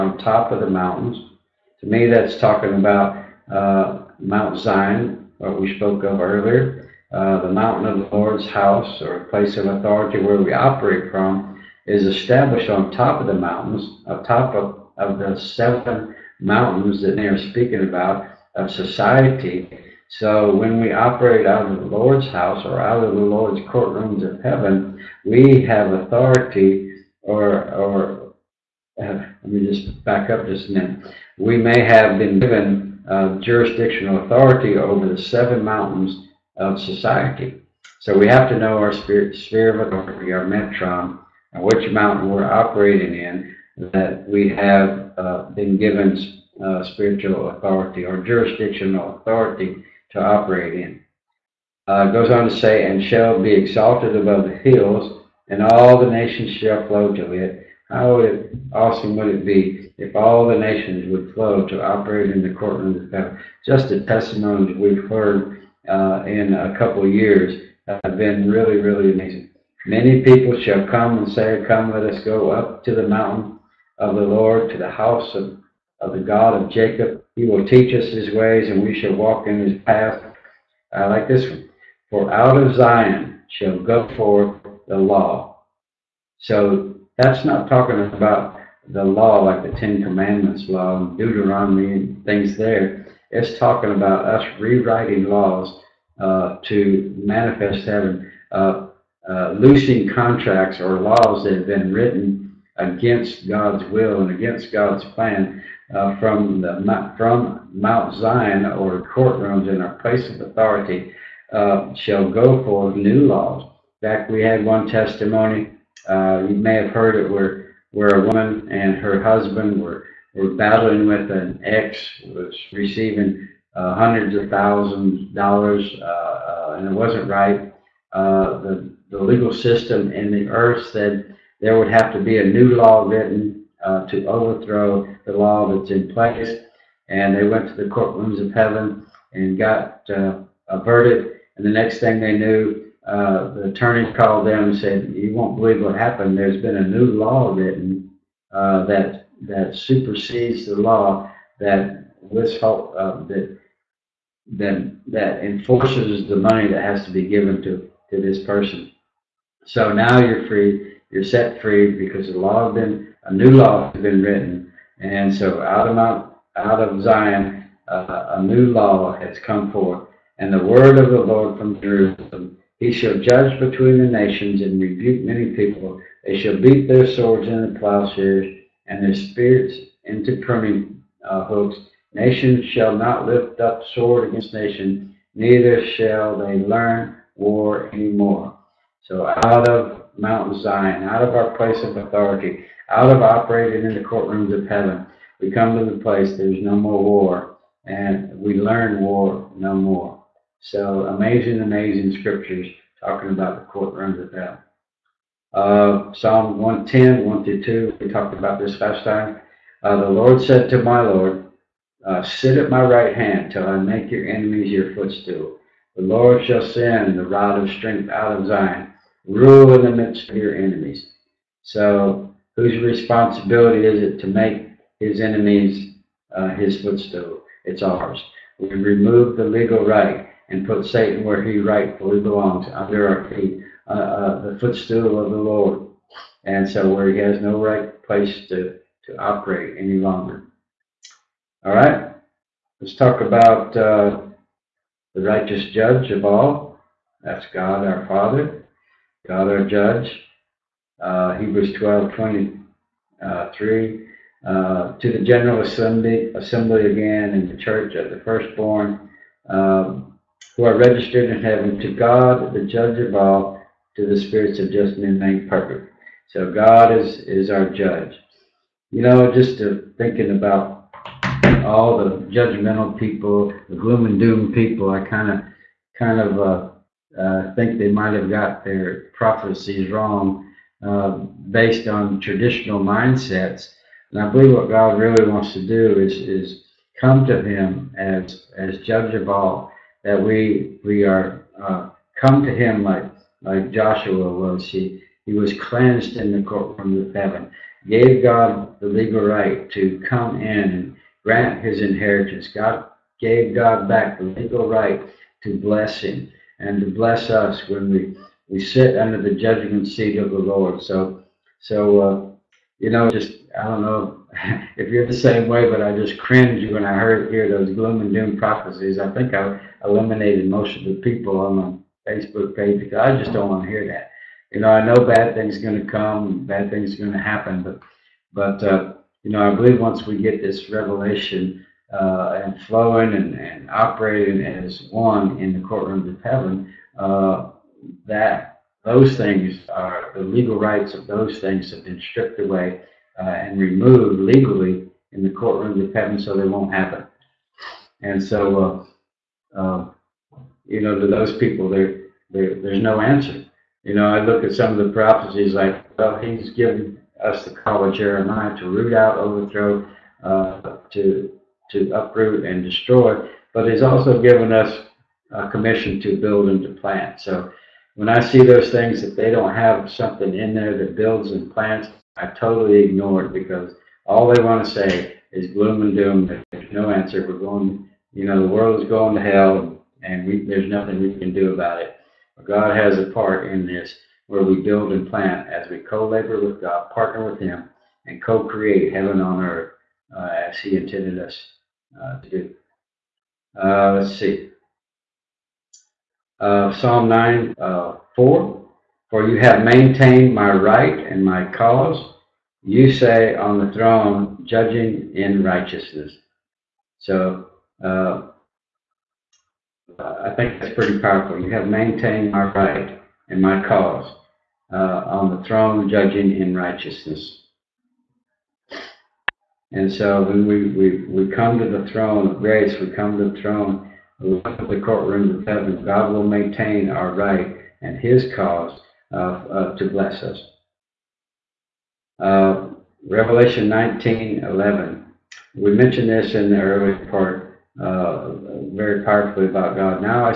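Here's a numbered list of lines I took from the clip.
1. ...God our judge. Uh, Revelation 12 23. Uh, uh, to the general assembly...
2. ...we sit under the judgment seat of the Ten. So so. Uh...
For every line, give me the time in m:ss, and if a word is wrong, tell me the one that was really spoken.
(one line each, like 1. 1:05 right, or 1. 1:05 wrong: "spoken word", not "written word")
1. 4:09 wrong: "Hebrews", not "Revelation"
2. 5:08 wrong: "Lord", not "Ten".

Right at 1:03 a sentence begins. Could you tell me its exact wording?
Just the testimonies we've heard uh, in a couple of years have been really, really amazing.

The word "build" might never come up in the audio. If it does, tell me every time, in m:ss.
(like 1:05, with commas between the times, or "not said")
6:06, 6:10, 6:24.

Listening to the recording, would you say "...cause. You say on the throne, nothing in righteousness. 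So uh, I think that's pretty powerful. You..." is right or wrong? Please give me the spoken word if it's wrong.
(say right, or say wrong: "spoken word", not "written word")
wrong: "judging", not "nothing".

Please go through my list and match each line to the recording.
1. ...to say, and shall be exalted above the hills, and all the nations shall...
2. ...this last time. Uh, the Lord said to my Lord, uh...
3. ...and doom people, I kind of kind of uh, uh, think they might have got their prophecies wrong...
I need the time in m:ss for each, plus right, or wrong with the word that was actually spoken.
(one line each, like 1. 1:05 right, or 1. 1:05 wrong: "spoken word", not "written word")
1. 0:52 right
2. 3:28 right
3. 4:34 right.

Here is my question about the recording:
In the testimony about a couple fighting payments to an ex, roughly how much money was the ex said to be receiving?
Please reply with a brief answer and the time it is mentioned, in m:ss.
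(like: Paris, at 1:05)
hundreds of thousands of dollars, at 2:03.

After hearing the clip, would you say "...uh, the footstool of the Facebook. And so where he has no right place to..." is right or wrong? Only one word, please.
wrong.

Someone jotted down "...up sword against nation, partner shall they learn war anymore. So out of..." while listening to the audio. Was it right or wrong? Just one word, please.
wrong.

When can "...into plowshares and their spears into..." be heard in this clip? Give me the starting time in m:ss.
2:57.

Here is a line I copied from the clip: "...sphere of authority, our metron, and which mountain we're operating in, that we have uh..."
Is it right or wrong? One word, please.
right.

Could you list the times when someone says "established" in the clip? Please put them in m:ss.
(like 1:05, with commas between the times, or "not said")
0:12.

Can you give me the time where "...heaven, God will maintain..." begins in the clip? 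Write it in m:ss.
7:05.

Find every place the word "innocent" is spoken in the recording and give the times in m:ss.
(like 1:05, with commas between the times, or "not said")
not said.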